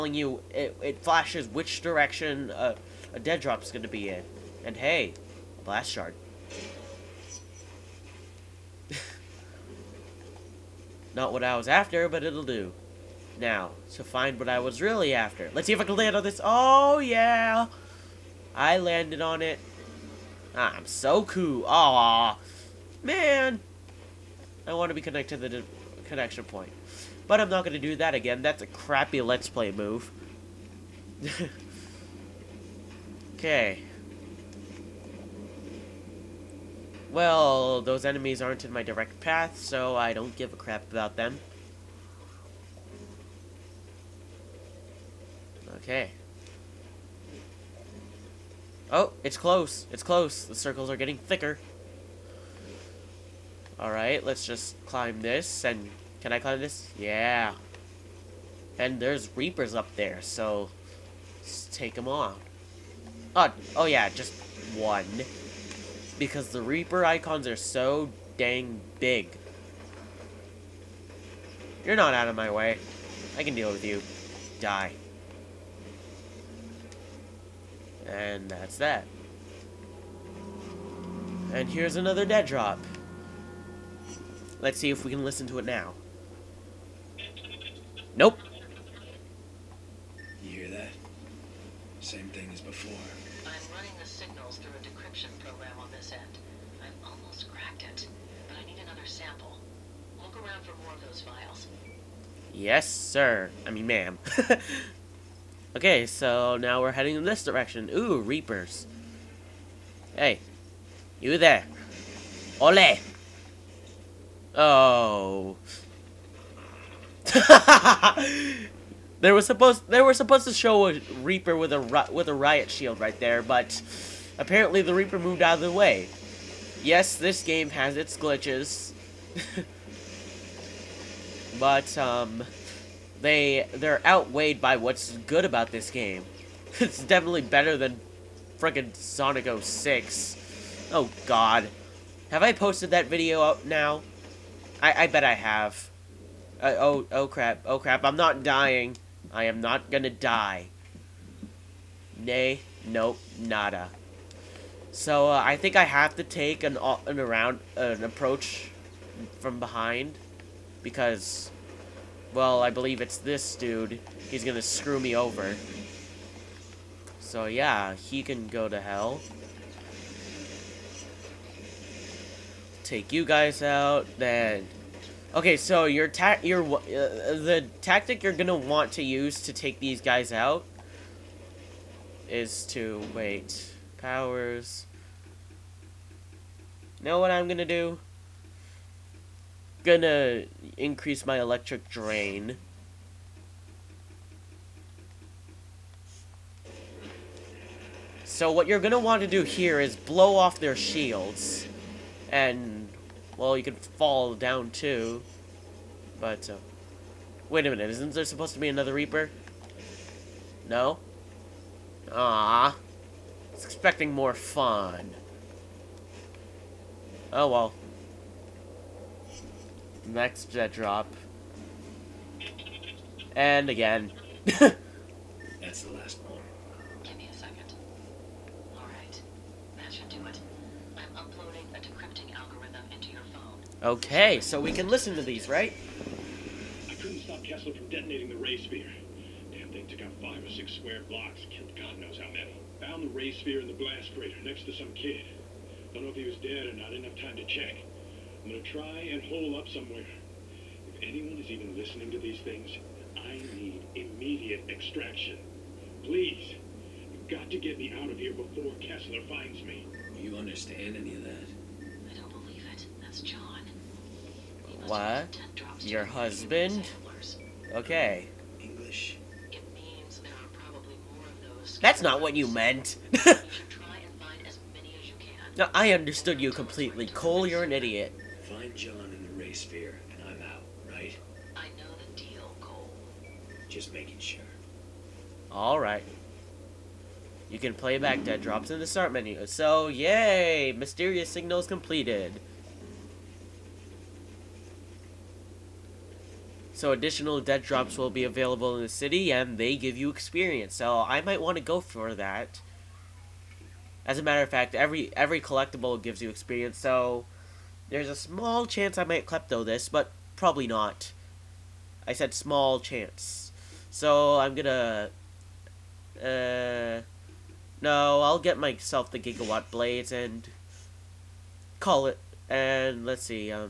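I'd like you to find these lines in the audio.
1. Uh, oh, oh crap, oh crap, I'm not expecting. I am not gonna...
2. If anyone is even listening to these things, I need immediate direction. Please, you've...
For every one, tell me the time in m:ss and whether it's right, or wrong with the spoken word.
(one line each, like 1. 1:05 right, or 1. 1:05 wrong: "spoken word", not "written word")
1. 2:26 wrong: "dying", not "expecting"
2. 4:10 wrong: "extraction", not "direction".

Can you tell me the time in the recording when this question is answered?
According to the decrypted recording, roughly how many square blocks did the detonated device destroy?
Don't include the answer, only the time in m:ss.
4:00.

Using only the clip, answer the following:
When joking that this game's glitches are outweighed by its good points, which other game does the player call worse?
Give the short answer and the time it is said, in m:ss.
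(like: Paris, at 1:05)
Sonic 06, at 2:18.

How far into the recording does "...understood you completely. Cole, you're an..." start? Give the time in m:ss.
4:35.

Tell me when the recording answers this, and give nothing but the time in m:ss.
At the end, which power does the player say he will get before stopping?
5:19.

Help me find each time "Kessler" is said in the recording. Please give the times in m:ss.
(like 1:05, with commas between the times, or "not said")
3:57, 4:18.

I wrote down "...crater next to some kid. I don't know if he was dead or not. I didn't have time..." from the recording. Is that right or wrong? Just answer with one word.
right.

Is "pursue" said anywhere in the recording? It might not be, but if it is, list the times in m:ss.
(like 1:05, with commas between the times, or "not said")
not said.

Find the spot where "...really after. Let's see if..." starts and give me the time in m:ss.
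0:14.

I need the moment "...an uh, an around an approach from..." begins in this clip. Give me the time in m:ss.
2:36.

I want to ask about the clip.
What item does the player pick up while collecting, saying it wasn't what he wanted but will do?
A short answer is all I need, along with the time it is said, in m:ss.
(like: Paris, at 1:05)
Blast shard, at 0:05.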